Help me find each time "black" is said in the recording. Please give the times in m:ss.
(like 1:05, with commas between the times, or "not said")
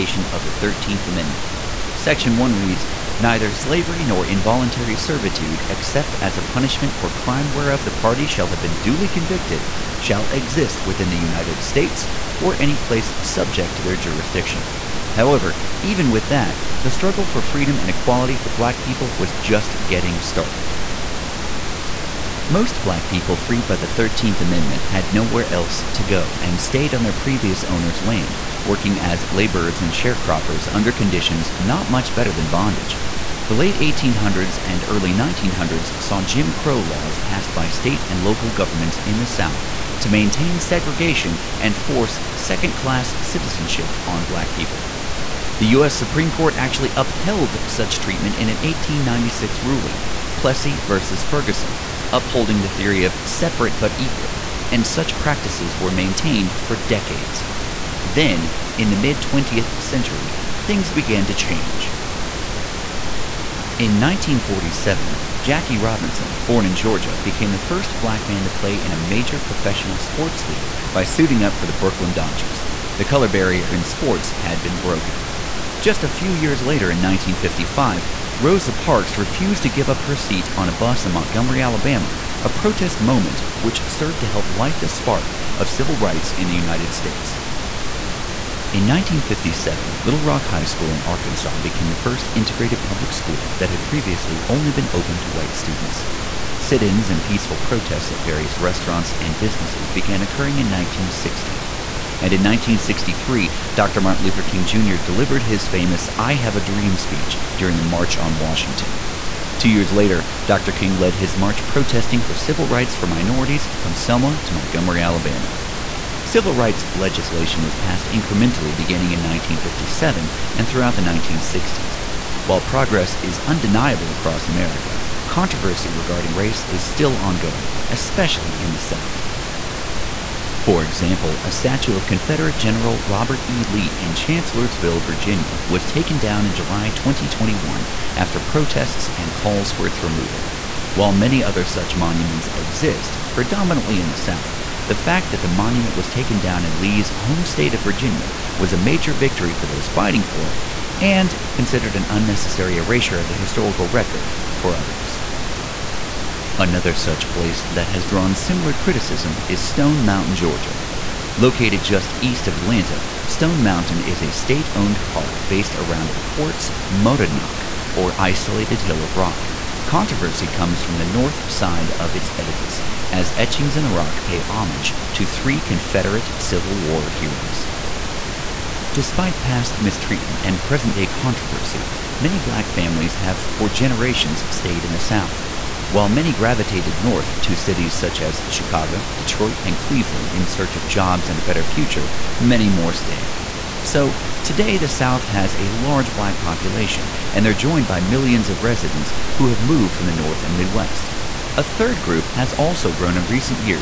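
0:18, 0:22, 0:44, 1:07, 3:02, 3:16.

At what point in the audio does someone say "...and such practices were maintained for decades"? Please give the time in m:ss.
0:54.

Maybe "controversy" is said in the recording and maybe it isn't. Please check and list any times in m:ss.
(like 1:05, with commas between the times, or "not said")
2:05, 2:49, 3:01.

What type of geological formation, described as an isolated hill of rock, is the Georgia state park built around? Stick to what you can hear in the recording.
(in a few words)
quartz monadnock.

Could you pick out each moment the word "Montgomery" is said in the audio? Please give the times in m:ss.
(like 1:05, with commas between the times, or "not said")
1:21, 1:54.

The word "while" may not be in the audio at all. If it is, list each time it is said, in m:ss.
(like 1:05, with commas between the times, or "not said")
2:02, 2:20, 3:05.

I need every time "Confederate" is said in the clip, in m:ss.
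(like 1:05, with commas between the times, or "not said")
2:12, 2:55.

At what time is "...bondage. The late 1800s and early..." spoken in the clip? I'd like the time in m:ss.
0:32.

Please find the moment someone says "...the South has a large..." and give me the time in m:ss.
3:14.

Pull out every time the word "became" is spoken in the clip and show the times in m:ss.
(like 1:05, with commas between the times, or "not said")
1:07, 1:31.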